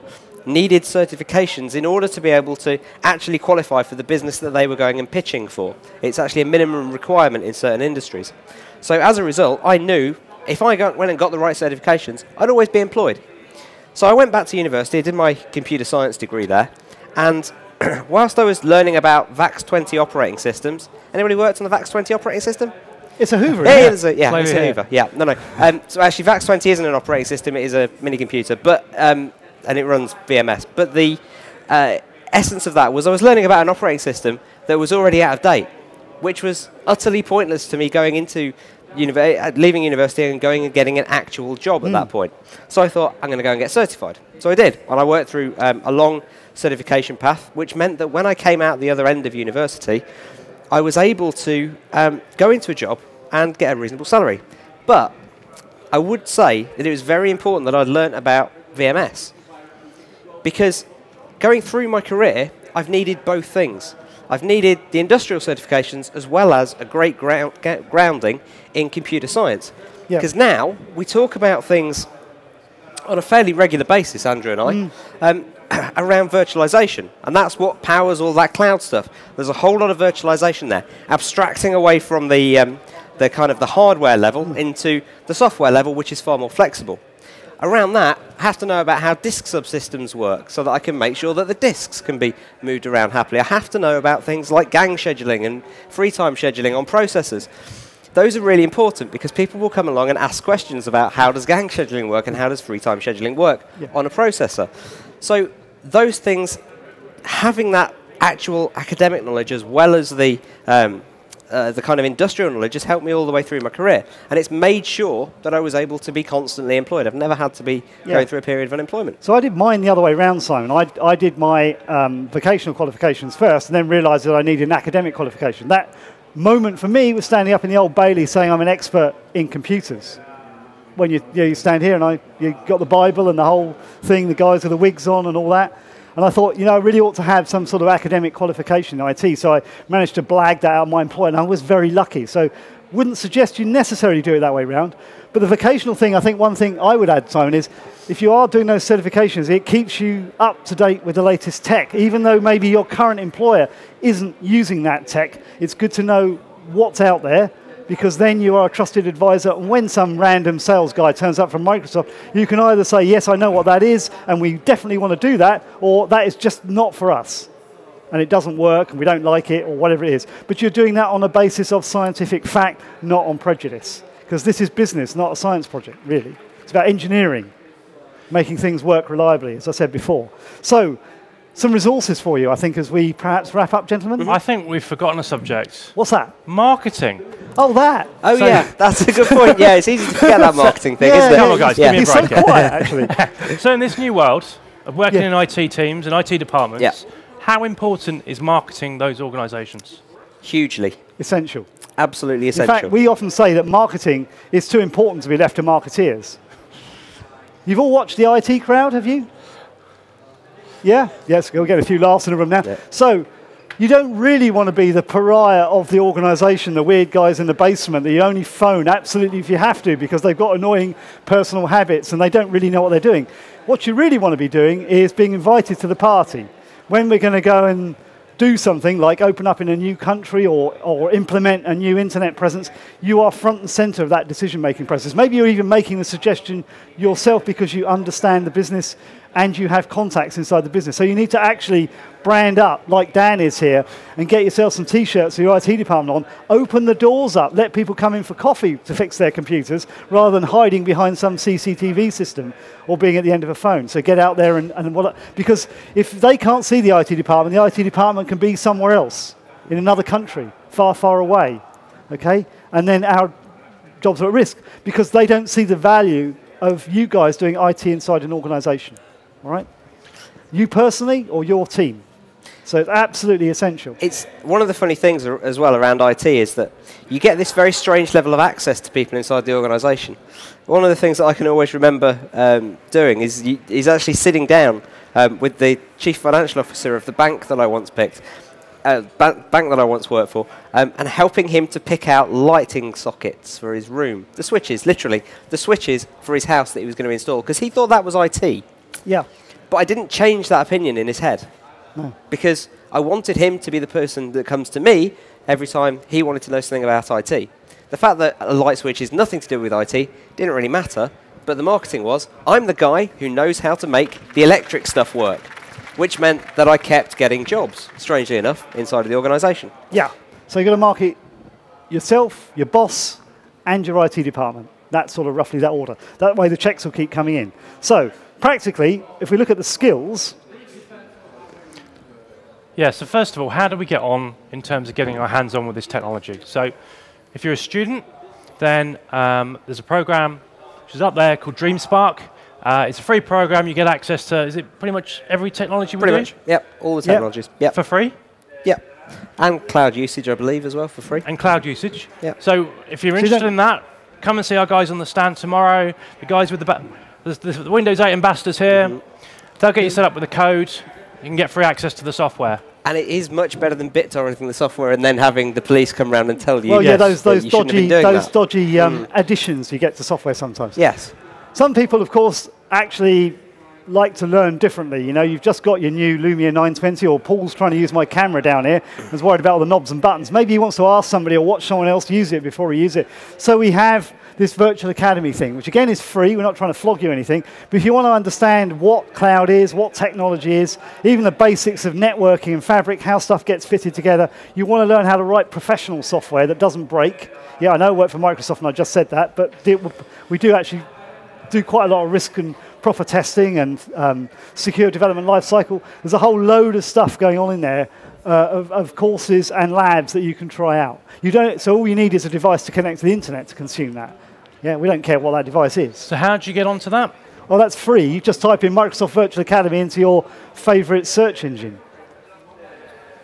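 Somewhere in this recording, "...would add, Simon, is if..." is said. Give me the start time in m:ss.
2:26.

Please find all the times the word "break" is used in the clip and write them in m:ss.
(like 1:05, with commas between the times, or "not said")
3:12, 6:36.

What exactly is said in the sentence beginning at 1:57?
I've never had to be yeah.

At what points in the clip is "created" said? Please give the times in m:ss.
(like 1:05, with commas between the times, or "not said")
not said.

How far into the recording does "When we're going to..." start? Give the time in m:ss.
3:46.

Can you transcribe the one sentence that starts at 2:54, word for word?
Because this is business, not a science project, really.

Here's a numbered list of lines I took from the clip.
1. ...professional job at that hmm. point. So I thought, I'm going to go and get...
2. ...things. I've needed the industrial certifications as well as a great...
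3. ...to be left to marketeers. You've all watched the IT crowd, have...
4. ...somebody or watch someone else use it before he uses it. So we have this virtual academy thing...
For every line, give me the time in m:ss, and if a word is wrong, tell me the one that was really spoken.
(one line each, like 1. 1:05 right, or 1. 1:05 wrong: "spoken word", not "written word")
1. 0:41 wrong: "actual", not "professional"
2. 1:03 right
3. 3:25 right
4. 6:21 right.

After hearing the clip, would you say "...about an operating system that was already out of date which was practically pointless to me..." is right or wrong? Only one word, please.
wrong.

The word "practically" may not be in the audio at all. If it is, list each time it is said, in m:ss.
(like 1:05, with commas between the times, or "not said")
5:28.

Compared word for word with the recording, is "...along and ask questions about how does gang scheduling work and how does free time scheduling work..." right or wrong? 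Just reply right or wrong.
right.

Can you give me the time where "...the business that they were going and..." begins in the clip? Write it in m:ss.
0:03.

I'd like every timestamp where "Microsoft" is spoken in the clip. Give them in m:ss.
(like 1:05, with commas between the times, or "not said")
2:41, 6:38, 6:58.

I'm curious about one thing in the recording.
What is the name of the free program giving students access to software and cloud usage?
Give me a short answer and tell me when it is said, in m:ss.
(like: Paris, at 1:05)
DreamSpark, at 5:41.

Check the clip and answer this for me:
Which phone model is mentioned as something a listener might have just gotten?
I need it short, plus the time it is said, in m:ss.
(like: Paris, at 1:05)
Lumia 920, at 6:16.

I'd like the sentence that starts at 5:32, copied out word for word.
Yeah, so first of all, how do we get on in terms of getting our hands on with this technology?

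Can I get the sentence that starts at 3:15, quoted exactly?
in IT teams and IT departments, yeah.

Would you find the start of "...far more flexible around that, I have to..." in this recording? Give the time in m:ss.
1:26.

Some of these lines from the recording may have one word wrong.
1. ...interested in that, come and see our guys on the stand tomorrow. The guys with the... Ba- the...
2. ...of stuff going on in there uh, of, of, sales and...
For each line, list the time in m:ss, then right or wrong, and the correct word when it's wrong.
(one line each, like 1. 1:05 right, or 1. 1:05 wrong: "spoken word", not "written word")
1. 5:53 right
2. 6:46 wrong: "courses", not "sales".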